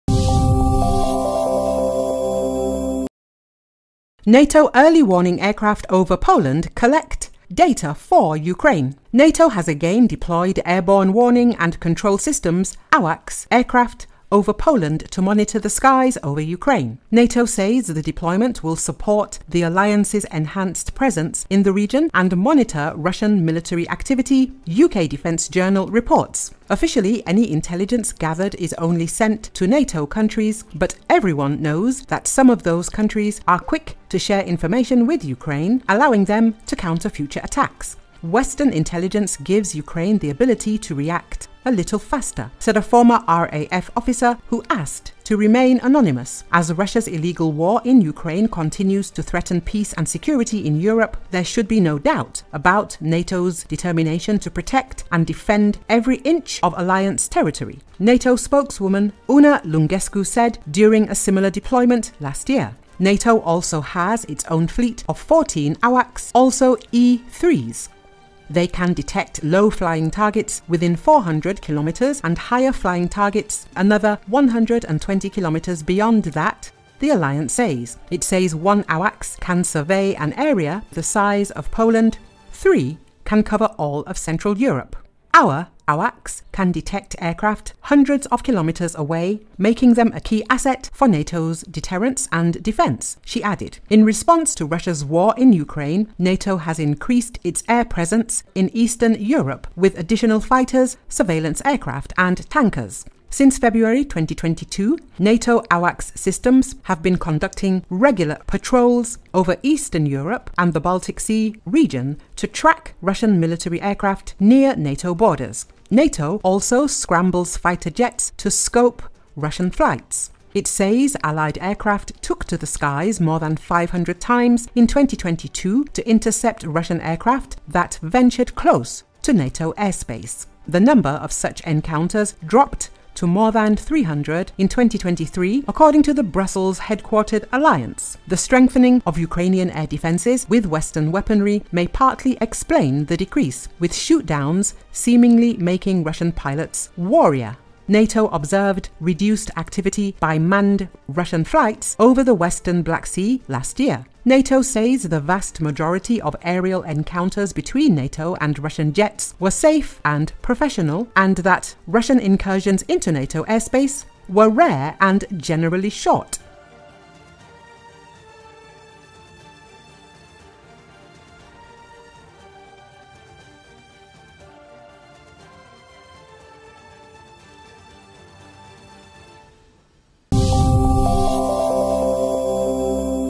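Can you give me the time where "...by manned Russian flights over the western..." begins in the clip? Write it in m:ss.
2:30.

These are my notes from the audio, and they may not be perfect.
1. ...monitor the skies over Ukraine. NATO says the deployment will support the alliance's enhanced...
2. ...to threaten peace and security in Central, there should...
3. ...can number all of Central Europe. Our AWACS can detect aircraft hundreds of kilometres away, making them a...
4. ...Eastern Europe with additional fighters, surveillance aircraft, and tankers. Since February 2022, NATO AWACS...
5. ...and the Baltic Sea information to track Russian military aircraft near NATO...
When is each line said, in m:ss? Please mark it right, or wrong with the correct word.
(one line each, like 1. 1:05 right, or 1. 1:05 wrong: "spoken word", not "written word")
1. 0:15 right
2. 0:49 wrong: "Europe", not "Central"
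3. 1:23 wrong: "cover", not "number"
4. 1:38 right
5. 1:50 wrong: "region", not "information".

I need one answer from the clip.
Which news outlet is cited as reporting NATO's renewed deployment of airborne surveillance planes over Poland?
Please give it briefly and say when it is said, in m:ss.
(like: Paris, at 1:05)
UK Defence Journal, at 0:24.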